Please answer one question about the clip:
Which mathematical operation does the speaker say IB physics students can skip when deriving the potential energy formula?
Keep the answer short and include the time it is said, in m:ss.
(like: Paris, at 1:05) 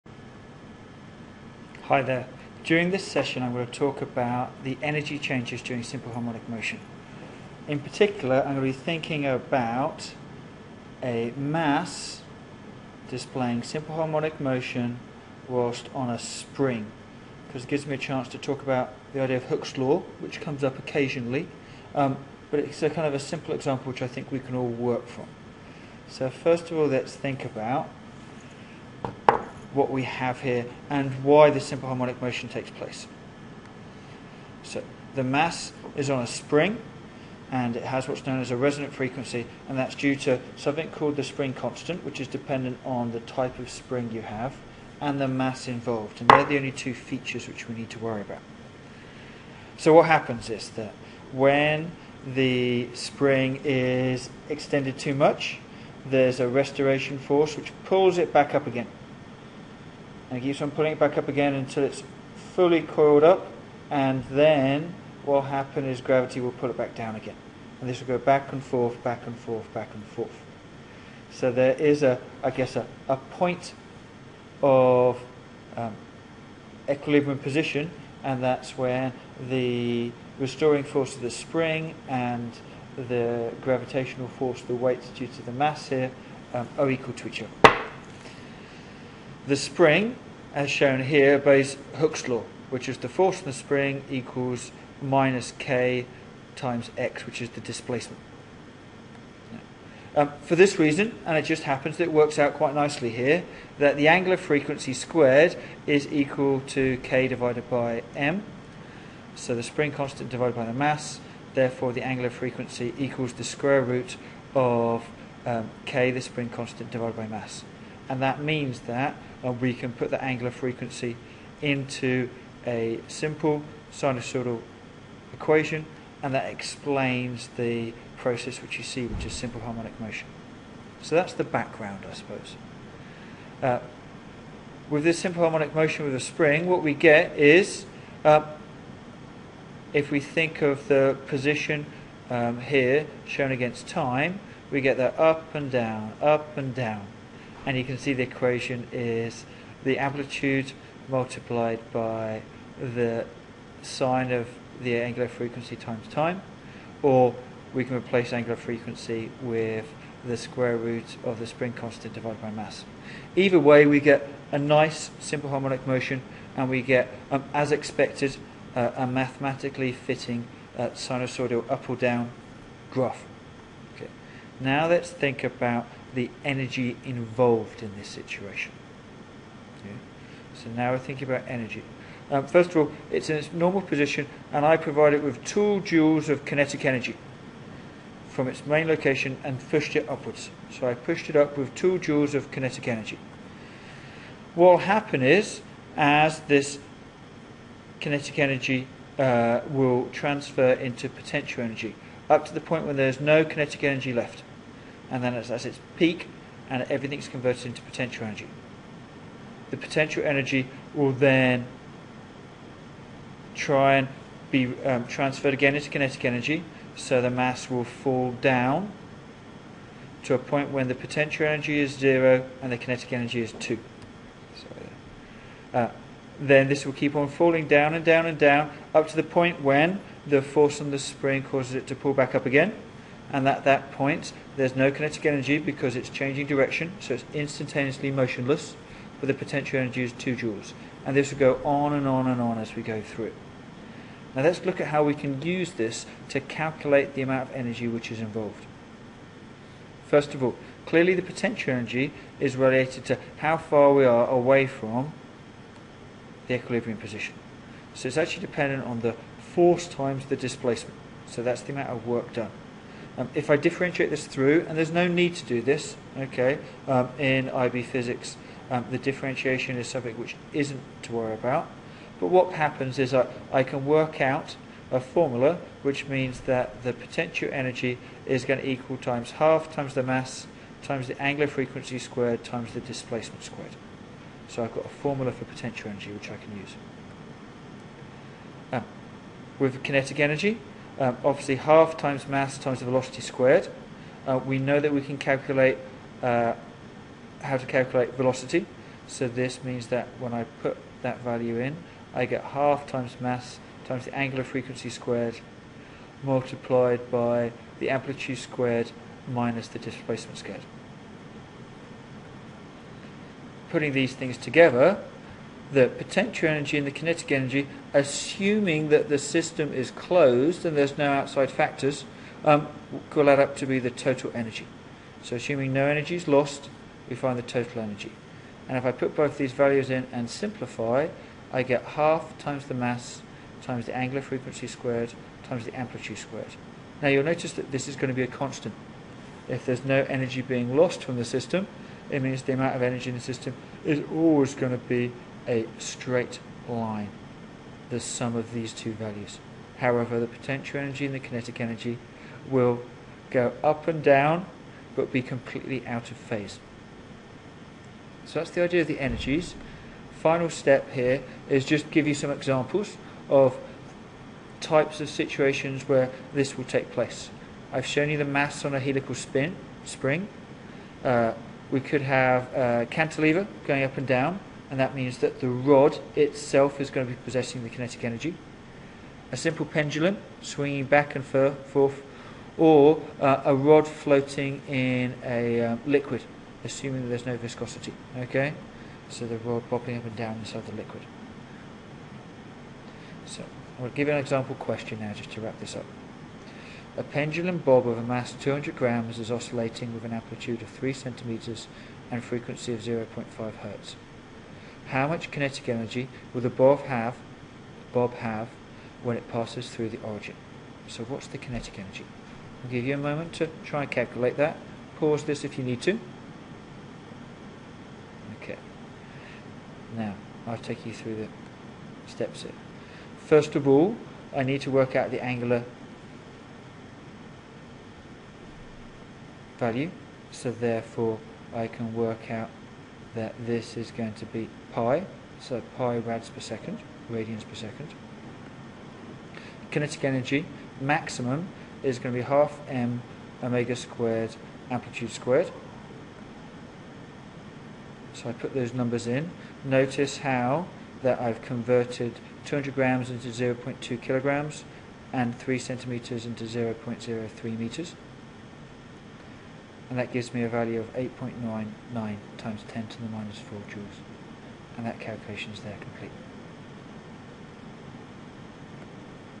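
differentiation, at 4:28.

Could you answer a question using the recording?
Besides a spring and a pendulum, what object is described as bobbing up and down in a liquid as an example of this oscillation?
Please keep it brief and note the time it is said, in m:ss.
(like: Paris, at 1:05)
a rod, at 6:23.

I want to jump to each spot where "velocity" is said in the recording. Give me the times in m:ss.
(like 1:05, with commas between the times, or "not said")
4:52, 4:58.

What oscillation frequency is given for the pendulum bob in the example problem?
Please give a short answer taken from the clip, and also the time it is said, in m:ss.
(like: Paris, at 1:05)
0.5 hertz, at 6:42.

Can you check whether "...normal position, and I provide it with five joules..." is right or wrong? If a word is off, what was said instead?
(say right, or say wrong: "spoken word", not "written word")
wrong: "two", not "five".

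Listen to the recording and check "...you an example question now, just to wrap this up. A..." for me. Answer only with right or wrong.
right.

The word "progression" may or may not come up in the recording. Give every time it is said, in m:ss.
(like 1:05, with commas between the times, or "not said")
not said.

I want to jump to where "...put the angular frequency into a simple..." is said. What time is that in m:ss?
1:59.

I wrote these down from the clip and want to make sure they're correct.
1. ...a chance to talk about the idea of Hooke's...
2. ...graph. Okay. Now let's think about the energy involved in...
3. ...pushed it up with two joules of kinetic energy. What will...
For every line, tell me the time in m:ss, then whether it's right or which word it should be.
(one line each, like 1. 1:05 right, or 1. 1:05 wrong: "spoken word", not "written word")
1. 0:17 right
2. 2:52 right
3. 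3:10 right.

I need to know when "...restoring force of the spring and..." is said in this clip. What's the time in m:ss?
1:20.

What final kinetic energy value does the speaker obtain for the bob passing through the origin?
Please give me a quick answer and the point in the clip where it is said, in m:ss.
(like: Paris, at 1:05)
8.99 × 10^-4 joules, at 7:40.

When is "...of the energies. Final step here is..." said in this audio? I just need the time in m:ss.
5:58.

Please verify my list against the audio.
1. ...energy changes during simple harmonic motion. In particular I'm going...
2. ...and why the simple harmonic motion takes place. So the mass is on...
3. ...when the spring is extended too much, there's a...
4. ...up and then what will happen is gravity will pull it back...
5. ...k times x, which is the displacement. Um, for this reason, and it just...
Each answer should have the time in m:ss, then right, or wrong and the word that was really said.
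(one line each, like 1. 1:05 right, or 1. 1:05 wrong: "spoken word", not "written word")
1. 0:04 right
2. 0:30 right
3. 0:51 right
4. 1:03 right
5. 1:35 right.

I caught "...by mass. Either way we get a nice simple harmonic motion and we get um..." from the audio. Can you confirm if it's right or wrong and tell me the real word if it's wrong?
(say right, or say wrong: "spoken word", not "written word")
right.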